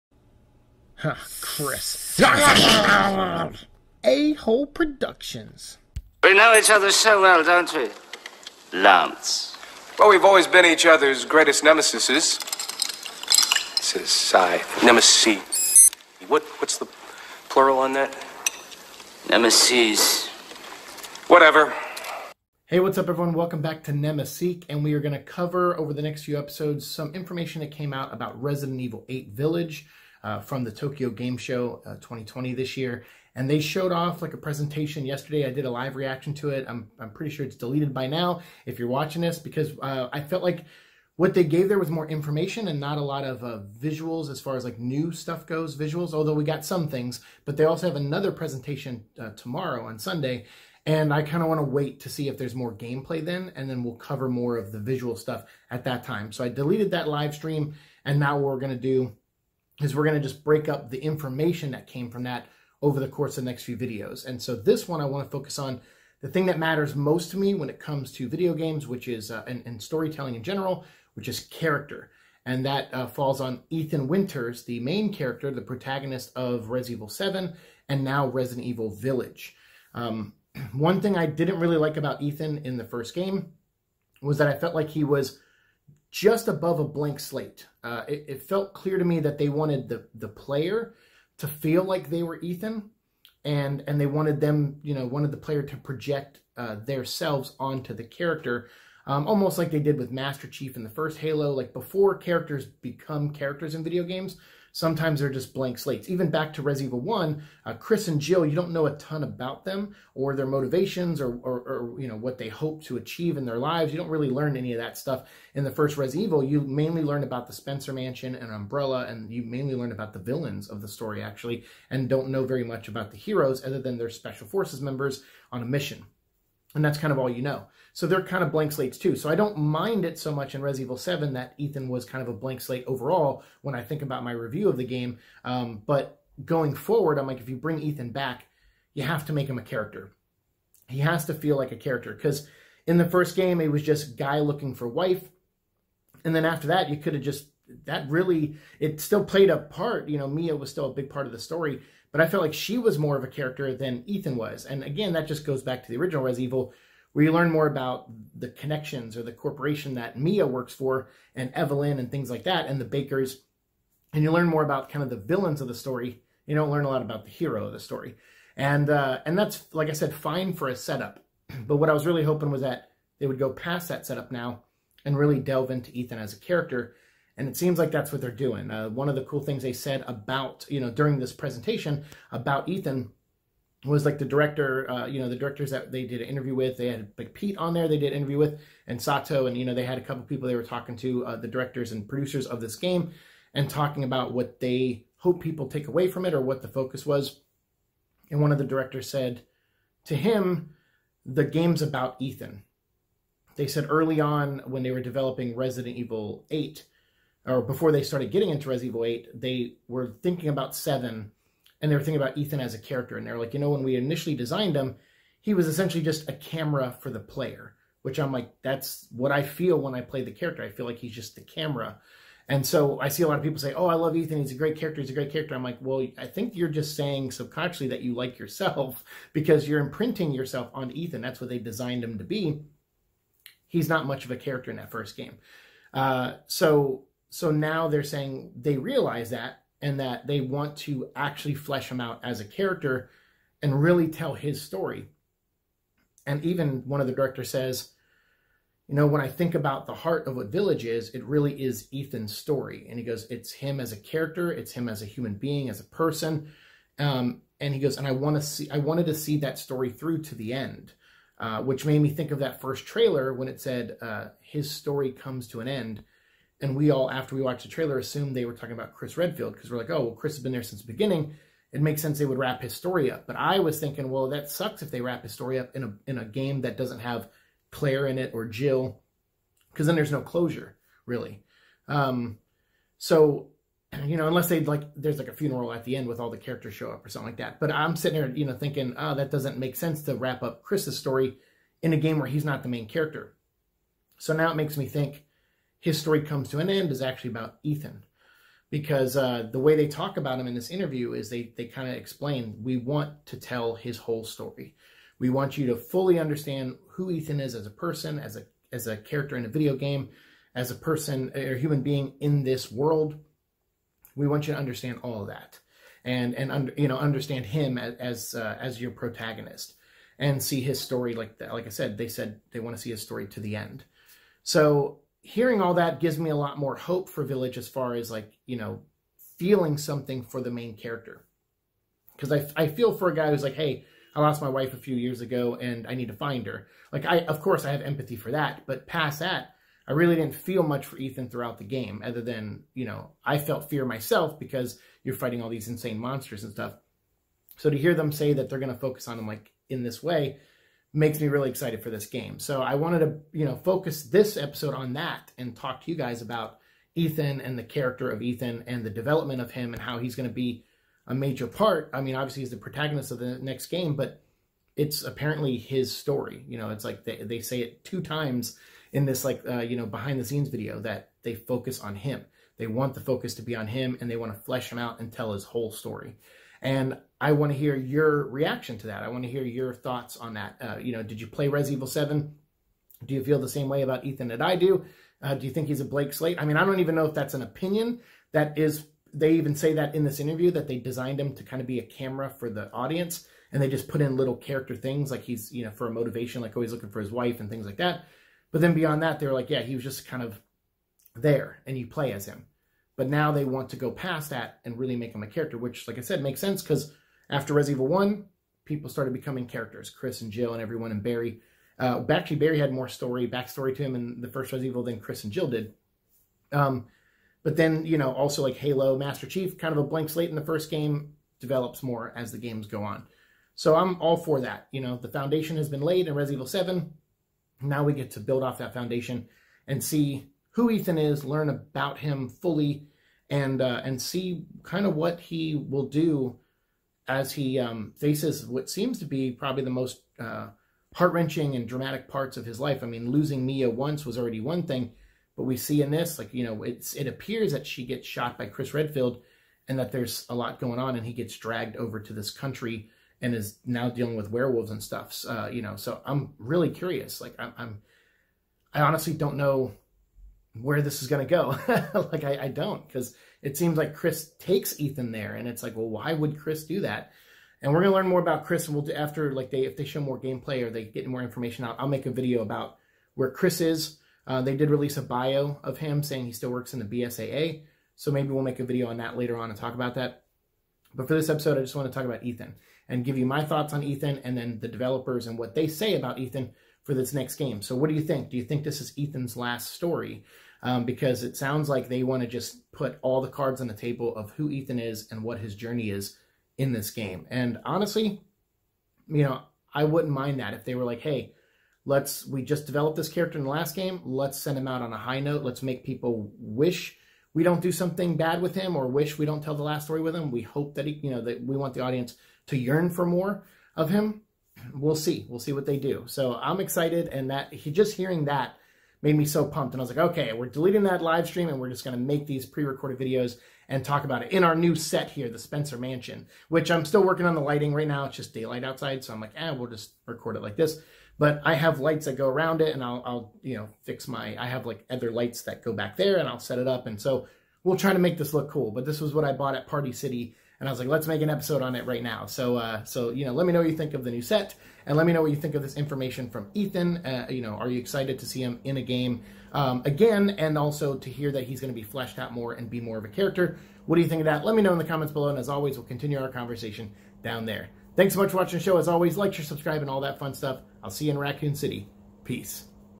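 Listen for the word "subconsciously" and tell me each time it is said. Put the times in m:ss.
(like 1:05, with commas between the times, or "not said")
3:47.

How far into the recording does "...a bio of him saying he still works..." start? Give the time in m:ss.
7:54.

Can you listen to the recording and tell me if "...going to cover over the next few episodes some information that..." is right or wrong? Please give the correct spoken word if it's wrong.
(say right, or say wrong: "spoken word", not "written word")
right.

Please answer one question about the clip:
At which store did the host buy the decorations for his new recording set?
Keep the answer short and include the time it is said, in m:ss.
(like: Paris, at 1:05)
Party City, at 8:59.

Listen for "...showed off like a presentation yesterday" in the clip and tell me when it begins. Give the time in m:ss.
0:33.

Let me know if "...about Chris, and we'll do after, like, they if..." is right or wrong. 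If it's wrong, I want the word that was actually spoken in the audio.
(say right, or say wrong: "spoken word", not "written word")
right.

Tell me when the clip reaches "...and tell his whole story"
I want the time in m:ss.
6:14.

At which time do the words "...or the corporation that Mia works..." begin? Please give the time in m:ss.
2:39.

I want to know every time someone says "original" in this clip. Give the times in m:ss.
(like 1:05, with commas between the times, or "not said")
2:35.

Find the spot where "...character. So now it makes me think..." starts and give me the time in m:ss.
4:52.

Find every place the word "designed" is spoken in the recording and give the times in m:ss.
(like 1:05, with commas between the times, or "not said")
3:34, 3:51, 6:30.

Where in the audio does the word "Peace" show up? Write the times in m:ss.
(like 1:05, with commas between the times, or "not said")
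9:22.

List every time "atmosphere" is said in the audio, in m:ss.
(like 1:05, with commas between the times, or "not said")
not said.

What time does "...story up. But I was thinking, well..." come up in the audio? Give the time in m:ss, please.
4:32.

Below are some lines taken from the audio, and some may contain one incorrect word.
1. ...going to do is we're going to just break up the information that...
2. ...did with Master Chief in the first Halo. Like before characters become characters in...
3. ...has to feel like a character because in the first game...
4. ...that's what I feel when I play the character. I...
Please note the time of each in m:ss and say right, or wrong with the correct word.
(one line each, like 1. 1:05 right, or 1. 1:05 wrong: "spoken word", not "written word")
1. 0:58 right
2. 1:39 right
3. 2:20 right
4. 3:38 right.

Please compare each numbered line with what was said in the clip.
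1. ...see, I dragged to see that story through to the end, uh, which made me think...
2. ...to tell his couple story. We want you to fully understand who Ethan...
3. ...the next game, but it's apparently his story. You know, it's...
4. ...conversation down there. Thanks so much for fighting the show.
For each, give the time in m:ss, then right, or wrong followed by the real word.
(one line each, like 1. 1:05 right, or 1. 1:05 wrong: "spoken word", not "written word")
1. 4:18 wrong: "wanted", not "dragged"
2. 5:03 wrong: "whole", not "couple"
3. 6:03 right
4. 9:16 wrong: "watching", not "fighting".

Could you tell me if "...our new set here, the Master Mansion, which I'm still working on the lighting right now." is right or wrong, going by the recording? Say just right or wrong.
wrong.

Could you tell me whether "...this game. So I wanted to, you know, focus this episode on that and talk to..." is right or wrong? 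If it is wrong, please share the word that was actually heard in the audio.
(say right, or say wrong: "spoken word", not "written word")
right.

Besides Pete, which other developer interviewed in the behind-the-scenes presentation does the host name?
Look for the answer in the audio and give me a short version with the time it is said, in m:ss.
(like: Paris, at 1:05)
Sato, at 3:09.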